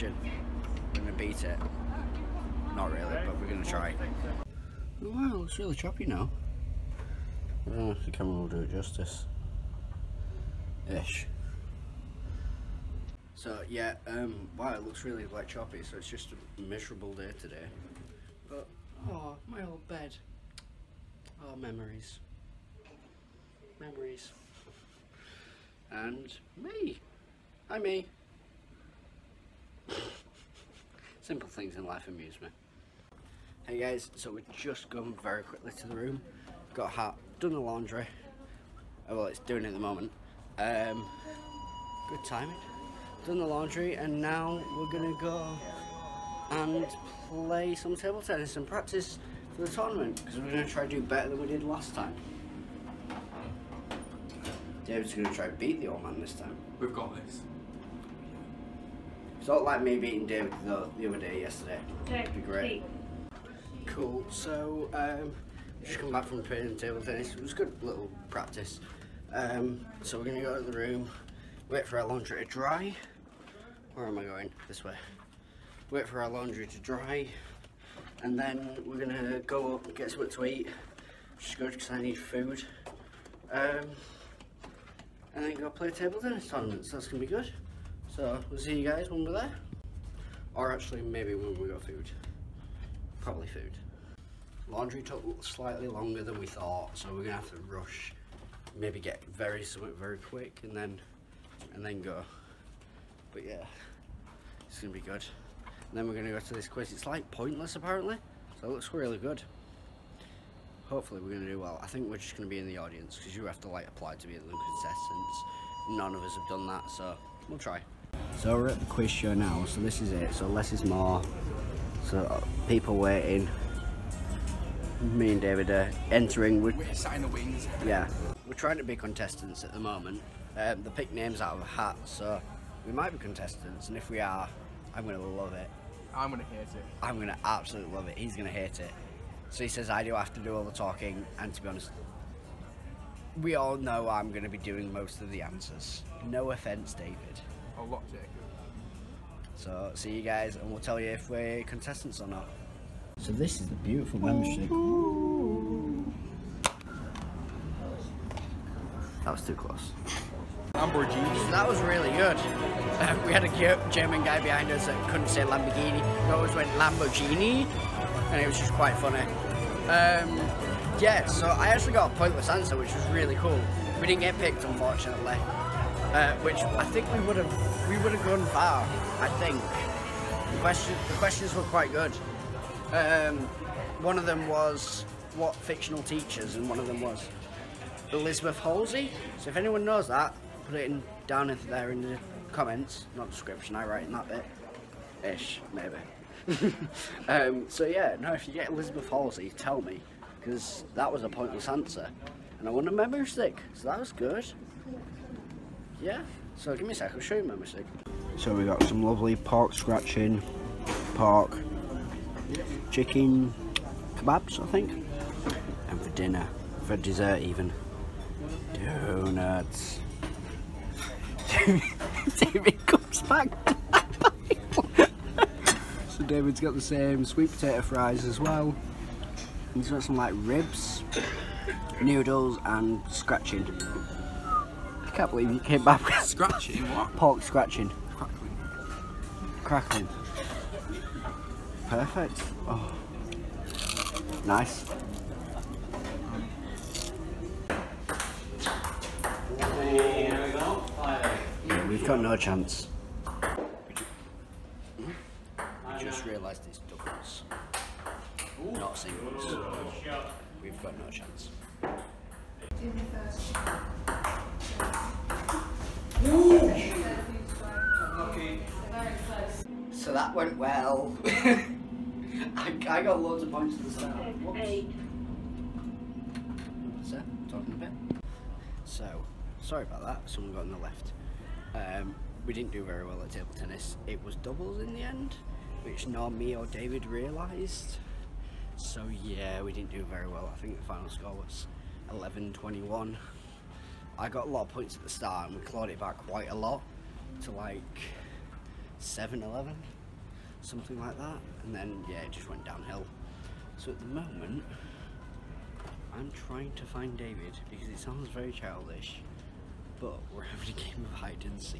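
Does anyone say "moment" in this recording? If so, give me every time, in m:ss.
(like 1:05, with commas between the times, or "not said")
0:39, 2:09, 5:04.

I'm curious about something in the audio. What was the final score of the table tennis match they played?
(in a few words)
11-21.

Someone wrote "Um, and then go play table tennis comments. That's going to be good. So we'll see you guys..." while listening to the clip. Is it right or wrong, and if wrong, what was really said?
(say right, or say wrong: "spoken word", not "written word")
wrong: "tournaments", not "comments".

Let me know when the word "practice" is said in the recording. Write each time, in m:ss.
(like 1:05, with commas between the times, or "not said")
0:48, 1:08.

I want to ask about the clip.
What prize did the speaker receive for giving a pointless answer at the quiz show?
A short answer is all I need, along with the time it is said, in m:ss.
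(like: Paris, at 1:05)
A memory stick, at 3:22.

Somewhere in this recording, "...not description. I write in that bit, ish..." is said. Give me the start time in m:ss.
3:13.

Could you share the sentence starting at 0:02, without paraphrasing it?
Not really, but we're going to try.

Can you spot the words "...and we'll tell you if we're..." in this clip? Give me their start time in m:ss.
2:30.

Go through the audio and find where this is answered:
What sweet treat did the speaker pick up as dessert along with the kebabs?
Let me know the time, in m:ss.
3:38.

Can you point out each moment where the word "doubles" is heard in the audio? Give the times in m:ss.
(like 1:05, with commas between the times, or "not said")
4:16, 4:44.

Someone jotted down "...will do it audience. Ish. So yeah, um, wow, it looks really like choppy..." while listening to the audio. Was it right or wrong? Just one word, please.
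wrong.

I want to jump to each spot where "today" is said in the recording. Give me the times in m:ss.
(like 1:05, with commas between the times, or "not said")
0:17.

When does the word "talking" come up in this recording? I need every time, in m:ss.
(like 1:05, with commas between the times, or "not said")
2:20, 4:37.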